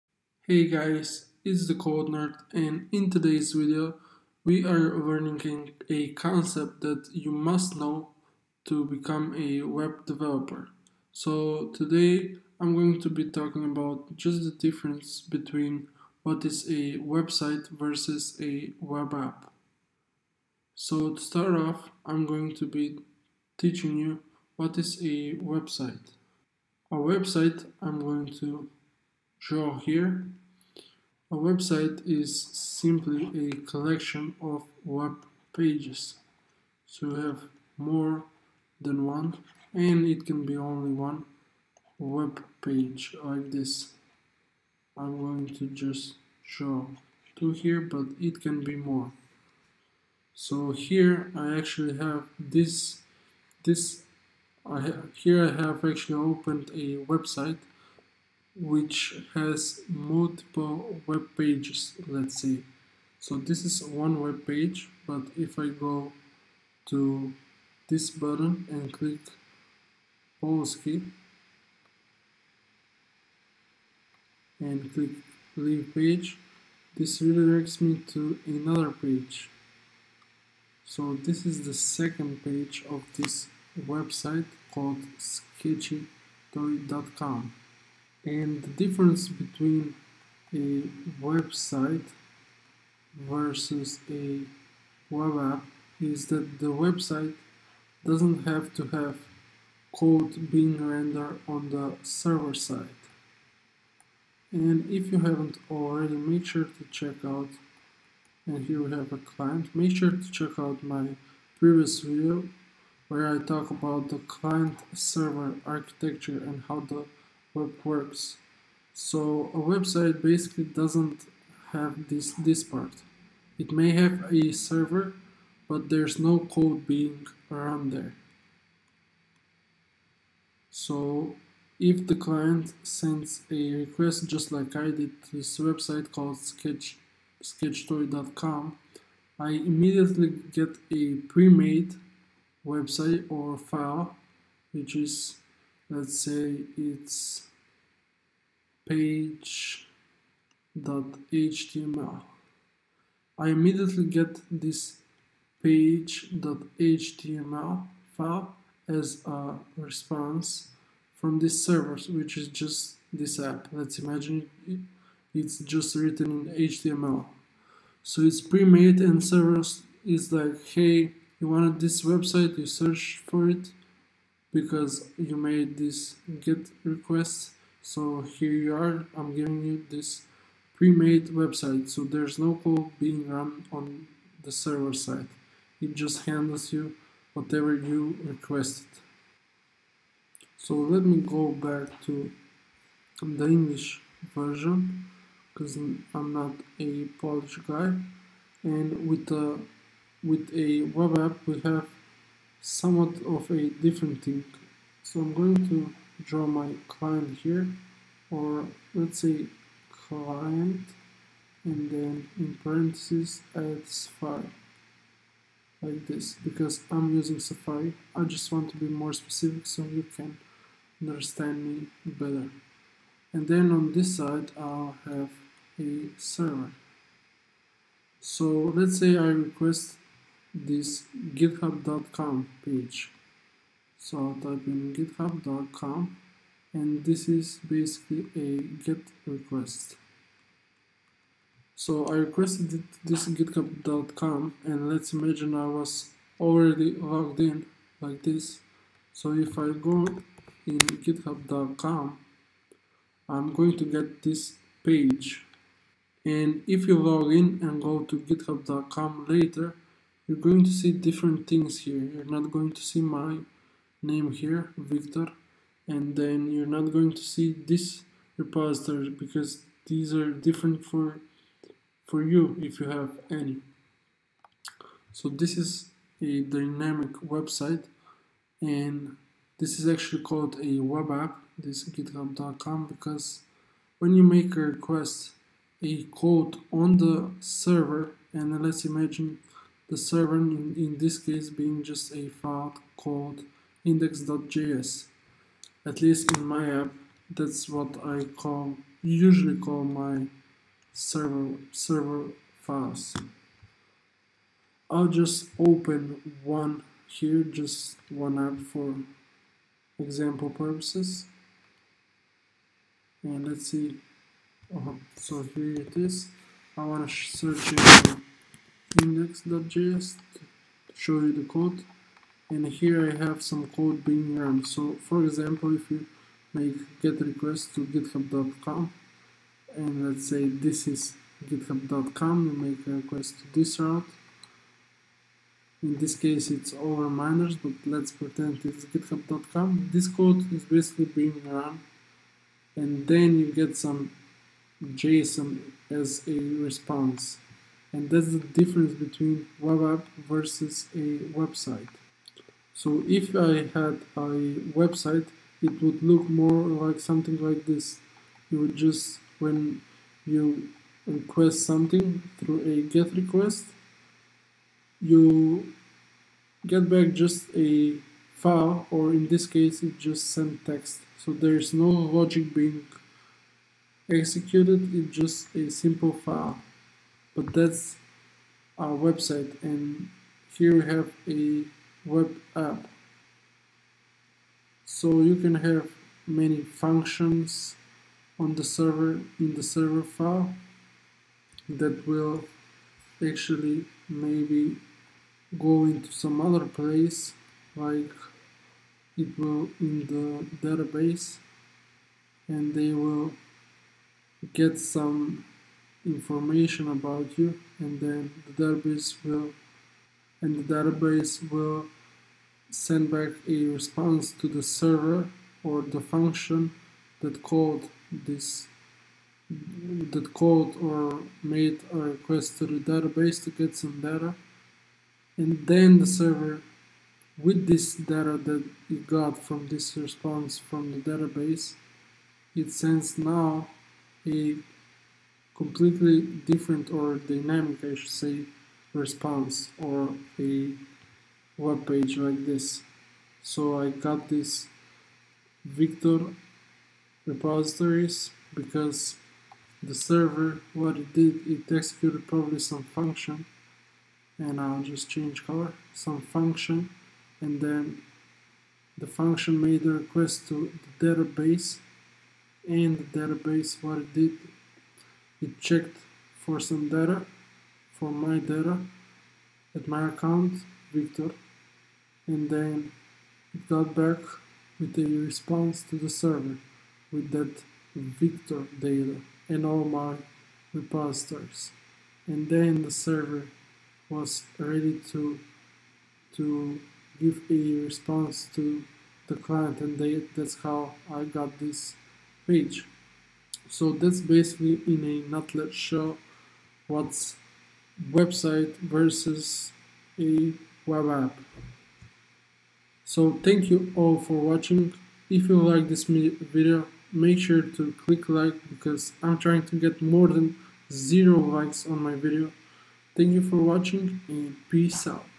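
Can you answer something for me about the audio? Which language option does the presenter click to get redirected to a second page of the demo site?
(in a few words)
Polski.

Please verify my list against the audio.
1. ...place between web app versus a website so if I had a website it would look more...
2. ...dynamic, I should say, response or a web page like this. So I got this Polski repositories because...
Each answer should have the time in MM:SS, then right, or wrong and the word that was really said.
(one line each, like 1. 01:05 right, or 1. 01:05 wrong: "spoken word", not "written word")
1. 05:48 wrong: "difference", not "place"
2. 07:17 wrong: "Victor", not "Polski".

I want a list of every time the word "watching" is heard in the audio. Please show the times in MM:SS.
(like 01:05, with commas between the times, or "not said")
08:24, 08:33.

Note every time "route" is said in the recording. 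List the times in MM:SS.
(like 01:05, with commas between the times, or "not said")
05:33.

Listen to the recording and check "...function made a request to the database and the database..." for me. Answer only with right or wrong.
right.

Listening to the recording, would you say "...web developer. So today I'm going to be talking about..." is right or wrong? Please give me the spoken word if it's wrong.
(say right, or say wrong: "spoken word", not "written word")
right.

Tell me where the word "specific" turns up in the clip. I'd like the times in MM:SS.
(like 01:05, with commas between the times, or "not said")
03:39.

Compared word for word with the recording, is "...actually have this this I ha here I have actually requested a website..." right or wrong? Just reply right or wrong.
wrong.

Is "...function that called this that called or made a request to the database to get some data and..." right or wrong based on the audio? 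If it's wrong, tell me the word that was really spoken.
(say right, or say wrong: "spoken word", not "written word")
right.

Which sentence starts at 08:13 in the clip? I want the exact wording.
So that's basically in a nutshell what's website versus a web app.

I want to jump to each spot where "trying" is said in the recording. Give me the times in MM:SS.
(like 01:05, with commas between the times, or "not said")
08:29.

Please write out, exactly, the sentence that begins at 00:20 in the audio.
So to start off, I'm going to be teaching you what is a website.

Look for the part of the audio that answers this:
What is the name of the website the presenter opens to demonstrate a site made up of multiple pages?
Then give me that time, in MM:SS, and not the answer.
01:25.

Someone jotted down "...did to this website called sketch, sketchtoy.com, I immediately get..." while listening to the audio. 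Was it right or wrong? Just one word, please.
right.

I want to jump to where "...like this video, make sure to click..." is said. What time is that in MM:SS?
08:25.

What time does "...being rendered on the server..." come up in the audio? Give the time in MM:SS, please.
01:40.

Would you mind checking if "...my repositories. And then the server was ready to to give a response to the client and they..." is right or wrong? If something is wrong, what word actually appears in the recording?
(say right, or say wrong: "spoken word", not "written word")
right.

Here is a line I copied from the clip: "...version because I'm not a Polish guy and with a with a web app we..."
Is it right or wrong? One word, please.
right.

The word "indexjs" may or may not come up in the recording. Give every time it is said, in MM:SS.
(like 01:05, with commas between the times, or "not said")
04:53, 05:18.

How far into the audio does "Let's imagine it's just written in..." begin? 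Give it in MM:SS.
02:43.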